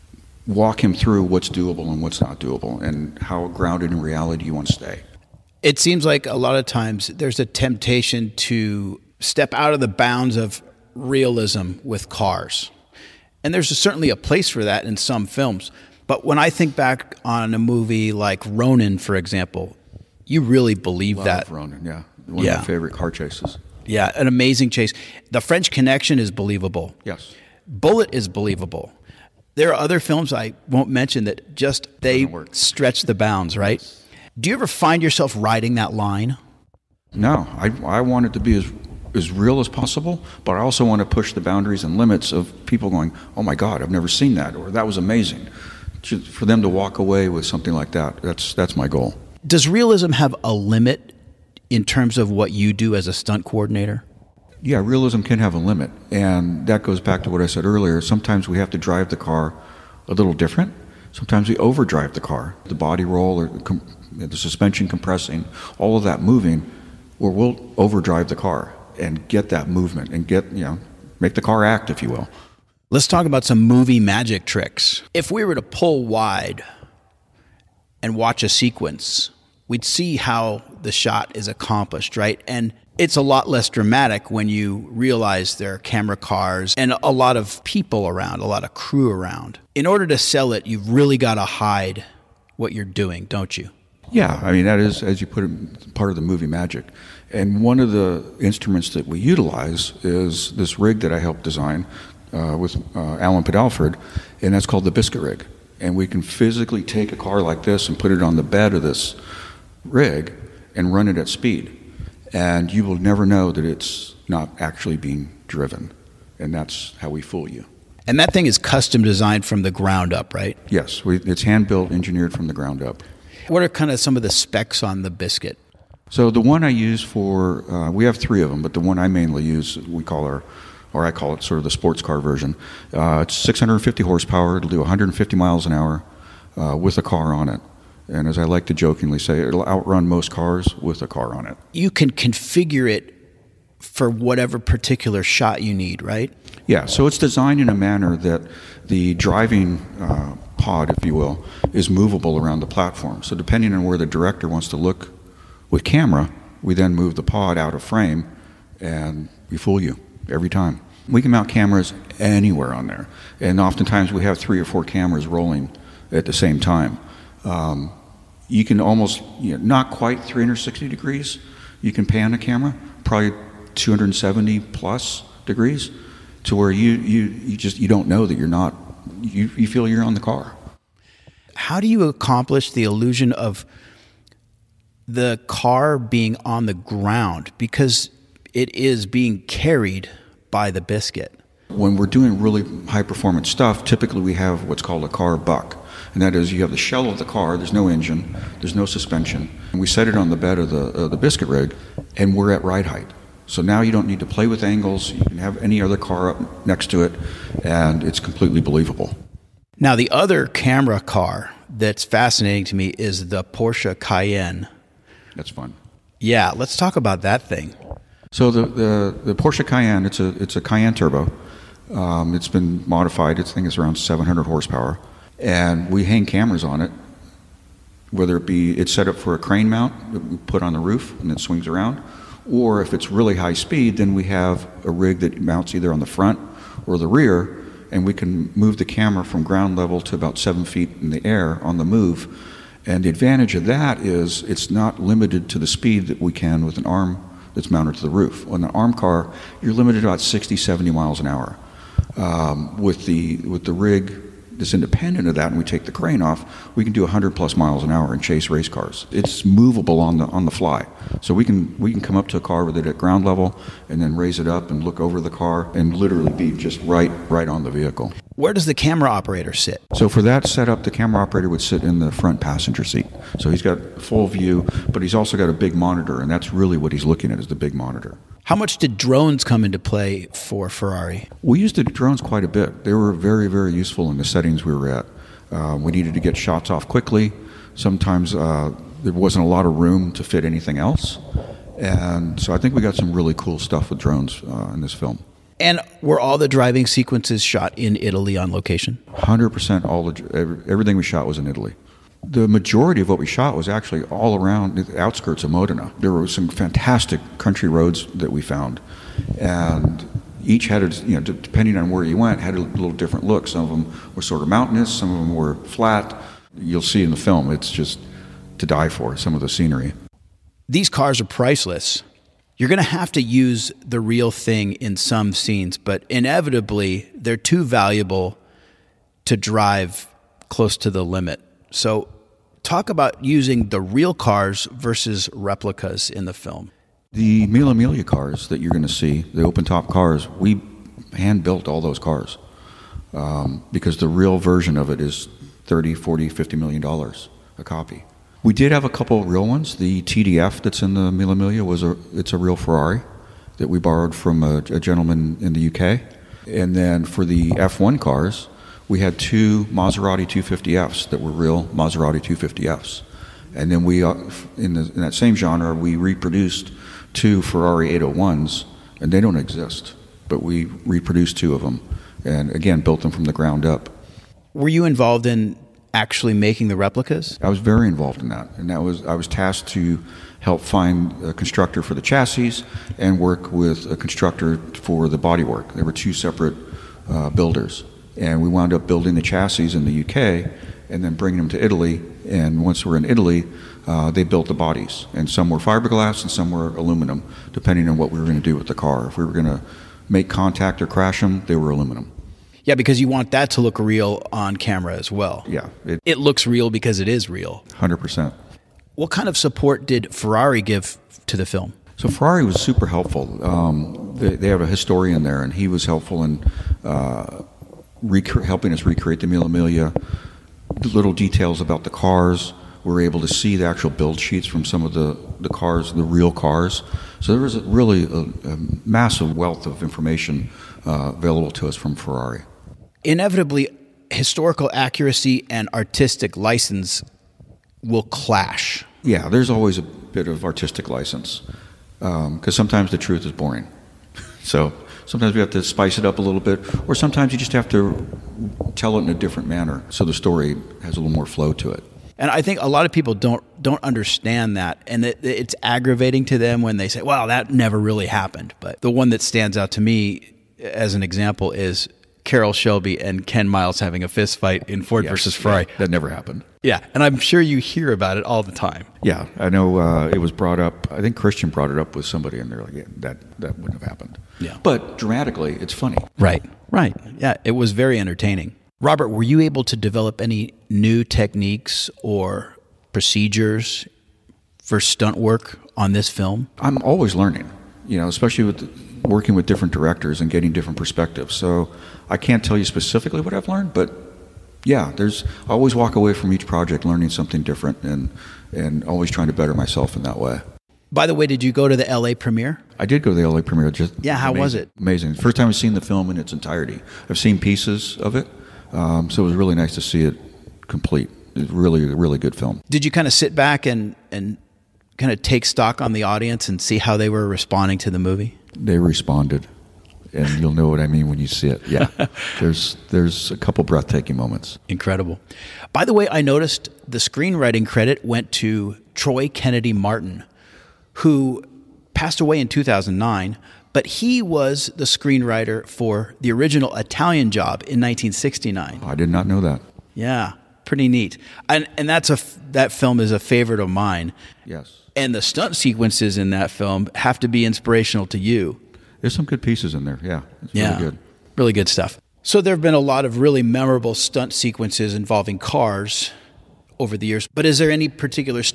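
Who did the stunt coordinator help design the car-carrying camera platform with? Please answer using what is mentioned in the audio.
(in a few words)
Alan Padelford.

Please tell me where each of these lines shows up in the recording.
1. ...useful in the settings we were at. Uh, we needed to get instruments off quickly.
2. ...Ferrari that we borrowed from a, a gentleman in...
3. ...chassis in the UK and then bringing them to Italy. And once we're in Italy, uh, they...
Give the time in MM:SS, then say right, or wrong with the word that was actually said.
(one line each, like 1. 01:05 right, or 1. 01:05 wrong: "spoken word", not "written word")
1. 04:43 wrong: "shots", not "instruments"
2. 05:52 right
3. 06:29 right.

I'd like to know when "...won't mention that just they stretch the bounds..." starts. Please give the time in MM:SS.
00:30.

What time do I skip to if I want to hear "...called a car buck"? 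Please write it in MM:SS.
03:14.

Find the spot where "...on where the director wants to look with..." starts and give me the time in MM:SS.
02:33.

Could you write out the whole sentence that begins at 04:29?
So for that setup, the camera operator would sit in the front passenger seat.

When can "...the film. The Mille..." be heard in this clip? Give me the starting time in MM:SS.
05:36.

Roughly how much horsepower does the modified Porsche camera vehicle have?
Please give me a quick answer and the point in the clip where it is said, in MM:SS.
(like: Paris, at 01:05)
700, at 03:43.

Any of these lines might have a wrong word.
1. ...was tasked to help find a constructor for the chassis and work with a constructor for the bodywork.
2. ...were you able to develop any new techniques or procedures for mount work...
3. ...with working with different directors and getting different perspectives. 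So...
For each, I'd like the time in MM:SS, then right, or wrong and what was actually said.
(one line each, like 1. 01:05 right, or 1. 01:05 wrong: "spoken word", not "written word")
1. 06:19 right
2. 07:59 wrong: "stunt", not "mount"
3. 08:08 right.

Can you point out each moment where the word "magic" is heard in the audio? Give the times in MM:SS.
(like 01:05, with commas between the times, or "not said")
01:14, 01:36.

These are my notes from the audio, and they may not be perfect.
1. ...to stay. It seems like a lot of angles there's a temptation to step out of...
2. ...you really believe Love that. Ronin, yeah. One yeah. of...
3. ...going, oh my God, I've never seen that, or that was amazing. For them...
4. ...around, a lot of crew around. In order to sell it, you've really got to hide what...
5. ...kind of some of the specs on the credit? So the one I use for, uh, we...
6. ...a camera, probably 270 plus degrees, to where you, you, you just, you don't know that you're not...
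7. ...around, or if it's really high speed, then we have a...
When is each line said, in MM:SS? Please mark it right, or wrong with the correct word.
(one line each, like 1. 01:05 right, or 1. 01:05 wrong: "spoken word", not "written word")
1. 00:04 wrong: "times", not "angles"
2. 00:20 right
3. 00:42 right
4. 01:28 right
5. 02:03 wrong: "biscuit", not "credit"
6. 02:52 right
7. 03:51 right.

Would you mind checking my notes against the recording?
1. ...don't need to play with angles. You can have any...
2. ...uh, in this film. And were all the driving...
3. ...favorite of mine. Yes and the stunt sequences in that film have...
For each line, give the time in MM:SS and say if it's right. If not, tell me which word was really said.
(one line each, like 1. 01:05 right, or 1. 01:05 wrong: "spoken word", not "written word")
1. 03:23 right
2. 04:54 right
3. 09:03 right.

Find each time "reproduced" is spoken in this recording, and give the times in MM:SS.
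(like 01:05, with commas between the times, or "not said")
06:05, 06:10.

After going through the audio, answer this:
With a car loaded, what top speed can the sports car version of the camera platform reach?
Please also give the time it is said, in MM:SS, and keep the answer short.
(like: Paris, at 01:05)
150 miles an hour, at 02:14.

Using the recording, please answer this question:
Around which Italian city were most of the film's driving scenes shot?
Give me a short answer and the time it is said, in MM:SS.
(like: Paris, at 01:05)
Modena, at 05:05.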